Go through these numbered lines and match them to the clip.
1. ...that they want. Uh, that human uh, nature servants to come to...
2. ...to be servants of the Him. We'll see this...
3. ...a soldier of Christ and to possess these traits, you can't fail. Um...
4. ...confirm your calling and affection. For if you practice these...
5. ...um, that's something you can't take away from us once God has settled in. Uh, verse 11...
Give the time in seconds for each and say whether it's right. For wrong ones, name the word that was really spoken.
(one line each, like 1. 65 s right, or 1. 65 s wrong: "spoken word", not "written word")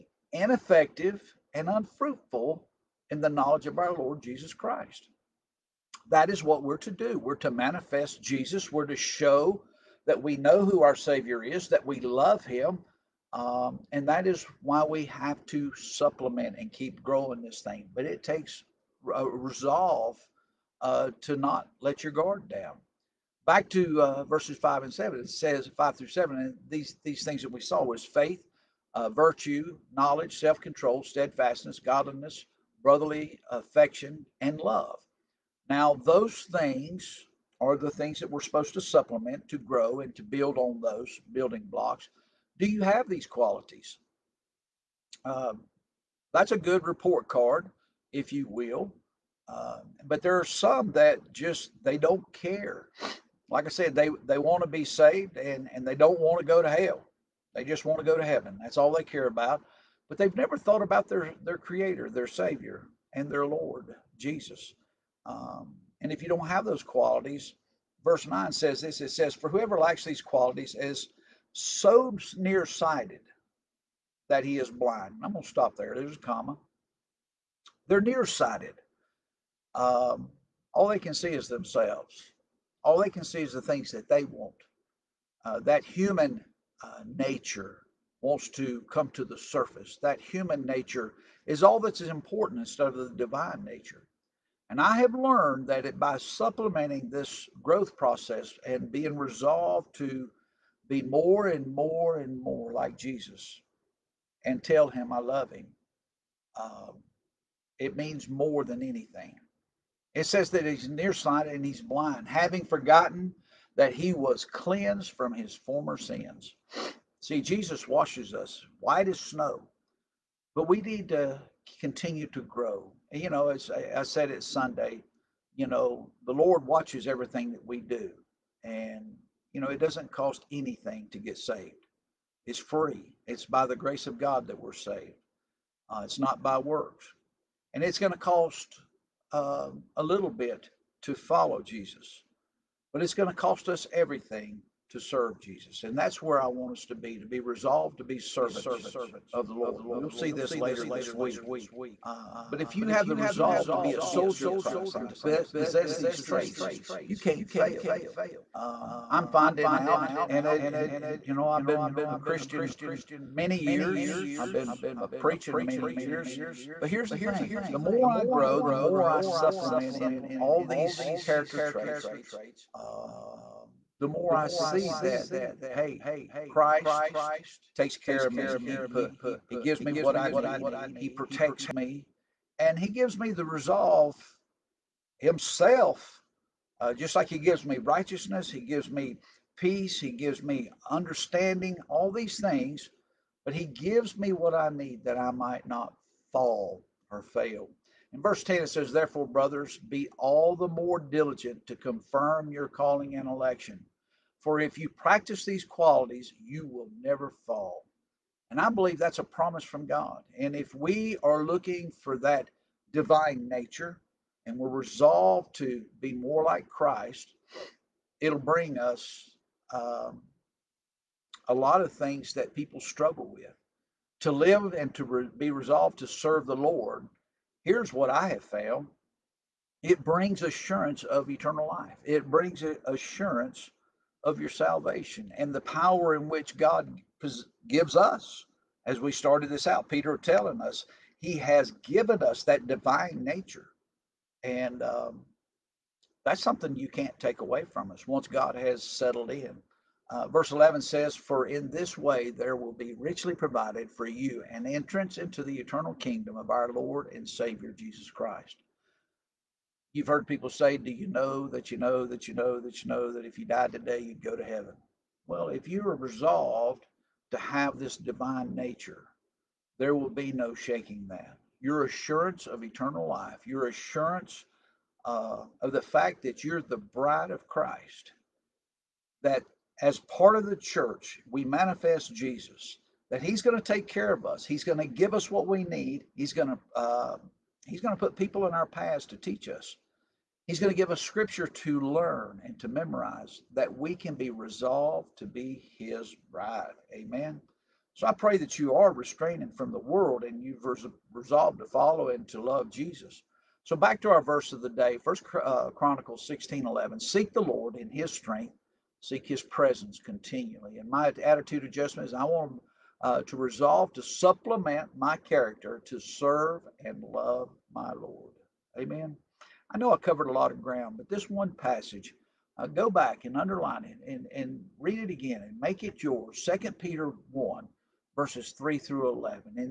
1. 83 s wrong: "wants", not "servants"
2. 147 s wrong: "Lord", not "Him"
3. 153 s right
4. 201 s wrong: "election", not "affection"
5. 244 s right.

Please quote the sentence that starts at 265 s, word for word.
Well, if you are resolved to have this divine nature, there will be no shaking that.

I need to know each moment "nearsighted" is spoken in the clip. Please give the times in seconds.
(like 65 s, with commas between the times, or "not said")
72 s, 78 s, 110 s.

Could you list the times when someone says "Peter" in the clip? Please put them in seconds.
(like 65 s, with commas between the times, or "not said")
239 s, 326 s.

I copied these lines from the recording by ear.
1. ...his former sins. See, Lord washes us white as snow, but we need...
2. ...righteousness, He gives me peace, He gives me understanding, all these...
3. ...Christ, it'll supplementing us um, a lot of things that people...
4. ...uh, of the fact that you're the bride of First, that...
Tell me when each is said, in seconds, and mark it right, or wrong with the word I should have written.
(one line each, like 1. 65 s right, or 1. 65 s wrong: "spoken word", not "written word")
1. 115 s wrong: "Jesus", not "Lord"
2. 187 s right
3. 216 s wrong: "bring", not "supplementing"
4. 275 s wrong: "Christ", not "First".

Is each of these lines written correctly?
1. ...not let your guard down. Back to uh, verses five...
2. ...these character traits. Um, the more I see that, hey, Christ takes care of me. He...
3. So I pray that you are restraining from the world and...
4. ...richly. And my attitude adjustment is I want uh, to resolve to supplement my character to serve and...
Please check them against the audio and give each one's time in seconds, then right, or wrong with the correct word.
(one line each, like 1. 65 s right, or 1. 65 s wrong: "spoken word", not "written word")
1. 21 s right
2. 170 s right
3. 297 s right
4. 309 s wrong: "continually", not "richly".